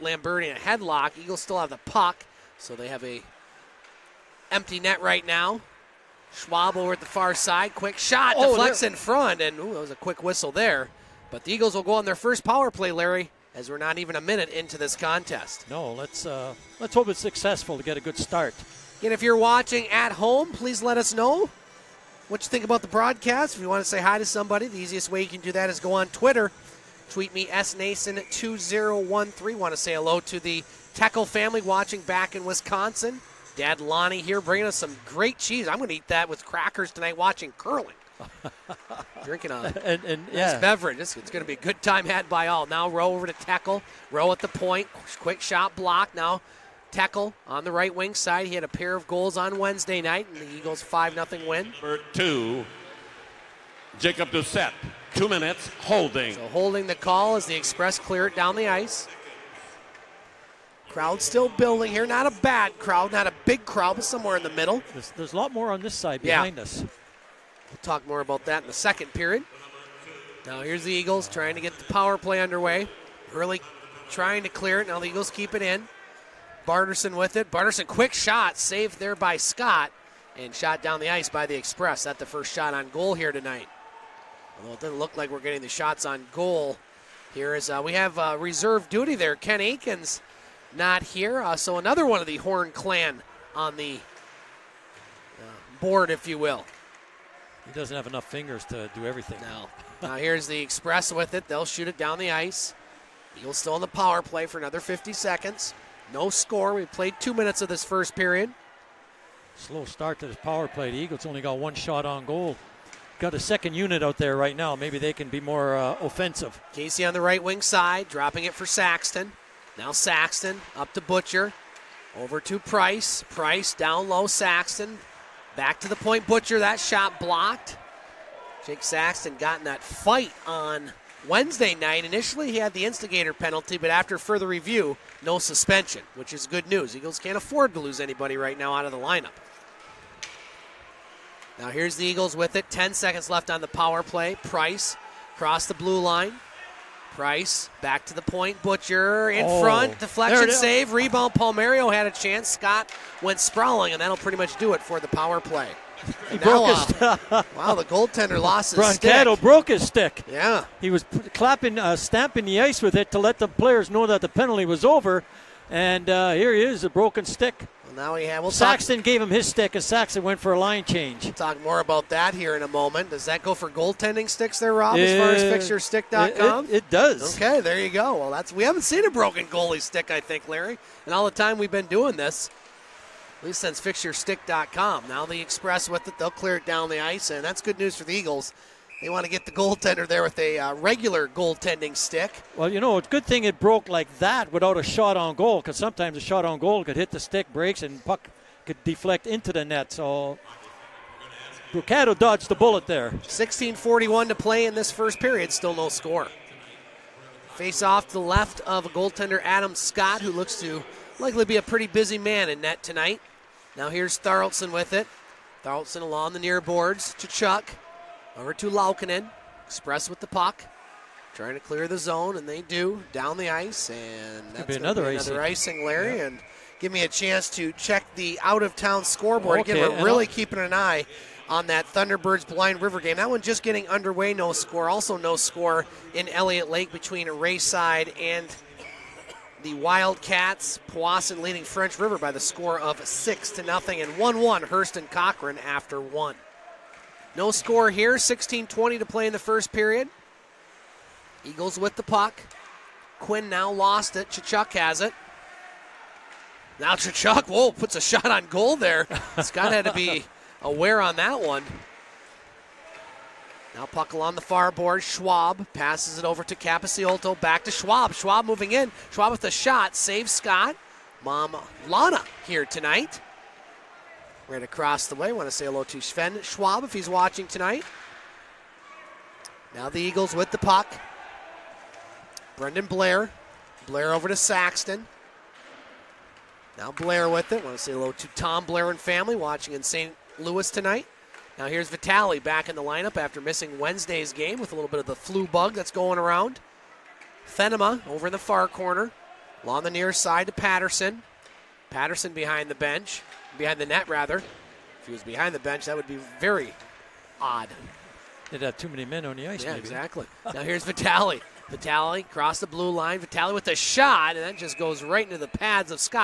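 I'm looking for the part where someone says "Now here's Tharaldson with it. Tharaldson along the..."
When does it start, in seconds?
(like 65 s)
213 s.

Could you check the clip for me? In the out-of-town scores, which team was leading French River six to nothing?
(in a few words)
Powassan.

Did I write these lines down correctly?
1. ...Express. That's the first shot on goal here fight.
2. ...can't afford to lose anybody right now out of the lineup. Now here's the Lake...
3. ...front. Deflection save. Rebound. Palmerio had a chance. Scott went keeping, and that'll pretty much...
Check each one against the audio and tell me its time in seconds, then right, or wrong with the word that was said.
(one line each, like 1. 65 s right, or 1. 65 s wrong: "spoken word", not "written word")
1. 81 s wrong: "tonight", not "fight"
2. 137 s wrong: "Eagles", not "Lake"
3. 149 s wrong: "sprawling", not "keeping".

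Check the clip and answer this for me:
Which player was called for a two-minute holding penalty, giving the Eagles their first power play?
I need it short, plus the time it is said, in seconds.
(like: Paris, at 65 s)
Jacob Doucette, at 53 s.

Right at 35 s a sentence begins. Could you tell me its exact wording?
I'm going to eat that with crackers tonight watching curling.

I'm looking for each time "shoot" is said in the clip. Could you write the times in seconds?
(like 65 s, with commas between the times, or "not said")
101 s.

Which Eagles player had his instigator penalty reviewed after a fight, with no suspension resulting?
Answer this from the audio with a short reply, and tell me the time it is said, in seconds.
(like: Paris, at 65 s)
Jake Saxton, at 128 s.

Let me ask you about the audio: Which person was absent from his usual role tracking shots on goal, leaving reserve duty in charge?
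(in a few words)
Ken Akins.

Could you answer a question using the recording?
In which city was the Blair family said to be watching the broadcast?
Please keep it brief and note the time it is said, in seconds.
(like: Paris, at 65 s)
St. Louis, at 289 s.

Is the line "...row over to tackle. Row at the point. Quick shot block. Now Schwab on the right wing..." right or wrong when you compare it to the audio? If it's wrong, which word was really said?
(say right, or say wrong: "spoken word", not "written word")
wrong: "Tackle", not "Schwab".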